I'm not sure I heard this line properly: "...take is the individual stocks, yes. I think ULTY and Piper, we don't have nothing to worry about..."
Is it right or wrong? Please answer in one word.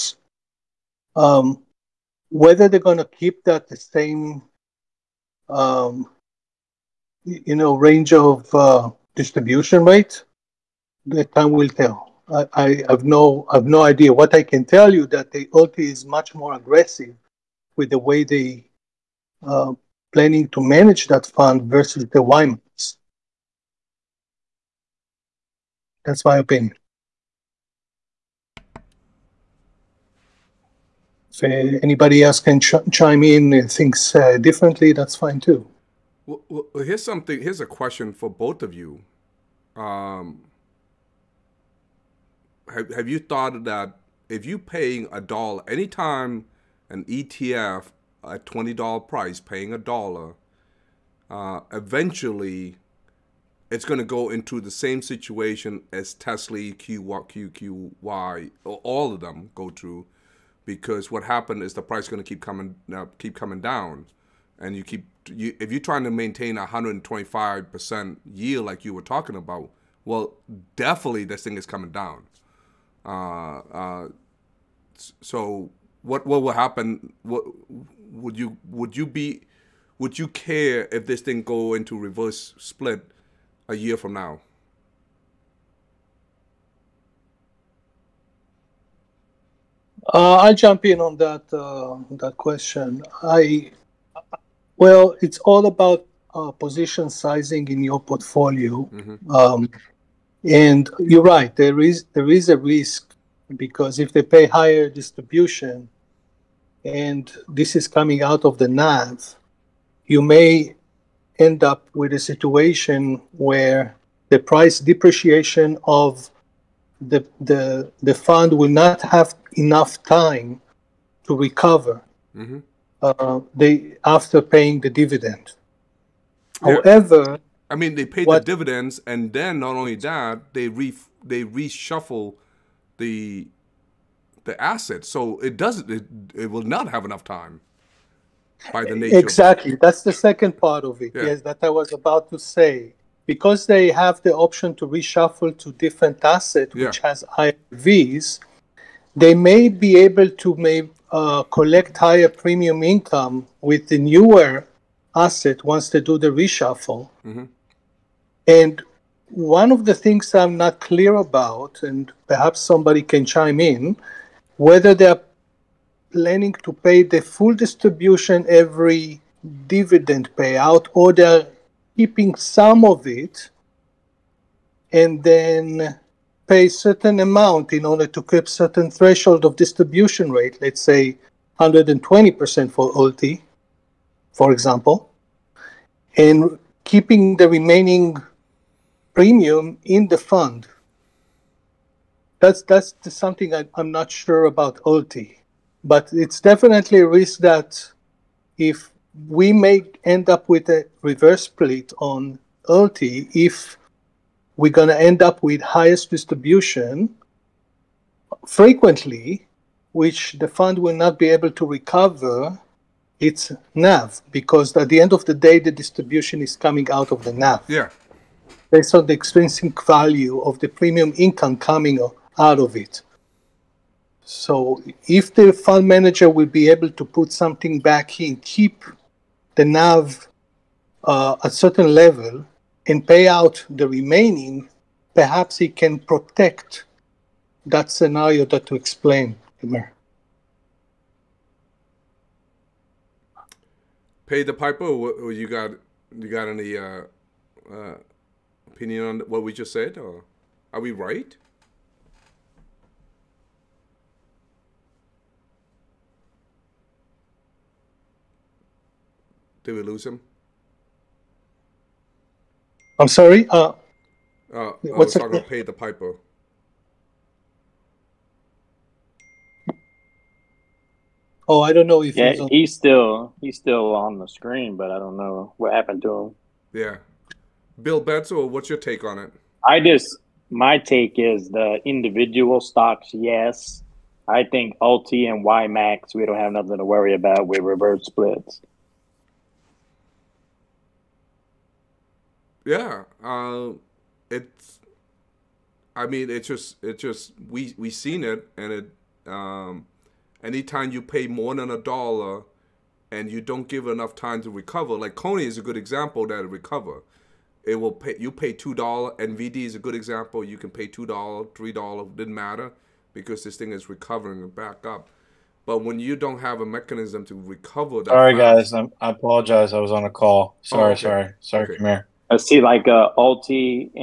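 wrong.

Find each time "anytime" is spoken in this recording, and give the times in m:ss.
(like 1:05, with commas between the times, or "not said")
0:45, 5:00.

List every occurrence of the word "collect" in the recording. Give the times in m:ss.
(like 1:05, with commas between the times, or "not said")
2:31.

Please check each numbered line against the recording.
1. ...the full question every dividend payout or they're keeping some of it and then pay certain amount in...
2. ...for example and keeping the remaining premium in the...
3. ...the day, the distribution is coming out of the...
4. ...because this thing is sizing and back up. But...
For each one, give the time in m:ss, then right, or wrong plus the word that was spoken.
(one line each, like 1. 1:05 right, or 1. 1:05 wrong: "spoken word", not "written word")
1. 2:47 wrong: "distribution", not "question"
2. 3:04 right
3. 3:35 right
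4. 5:13 wrong: "recovering", not "sizing".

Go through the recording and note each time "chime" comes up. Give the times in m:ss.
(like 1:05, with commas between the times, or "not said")
0:32, 2:43.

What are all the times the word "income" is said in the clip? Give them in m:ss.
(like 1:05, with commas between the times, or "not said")
2:32, 3:41.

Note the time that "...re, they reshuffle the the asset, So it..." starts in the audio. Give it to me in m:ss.
2:10.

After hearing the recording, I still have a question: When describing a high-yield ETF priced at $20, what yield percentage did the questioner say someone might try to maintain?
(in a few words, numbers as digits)
125%.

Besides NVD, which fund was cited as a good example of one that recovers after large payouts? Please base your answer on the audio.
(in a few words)
CONY.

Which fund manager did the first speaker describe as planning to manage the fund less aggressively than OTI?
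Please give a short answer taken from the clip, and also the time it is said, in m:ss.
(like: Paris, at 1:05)
Wymans, at 0:22.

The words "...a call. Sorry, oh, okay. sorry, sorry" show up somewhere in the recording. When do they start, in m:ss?
5:20.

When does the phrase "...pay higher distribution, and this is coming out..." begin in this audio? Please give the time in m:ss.
1:44.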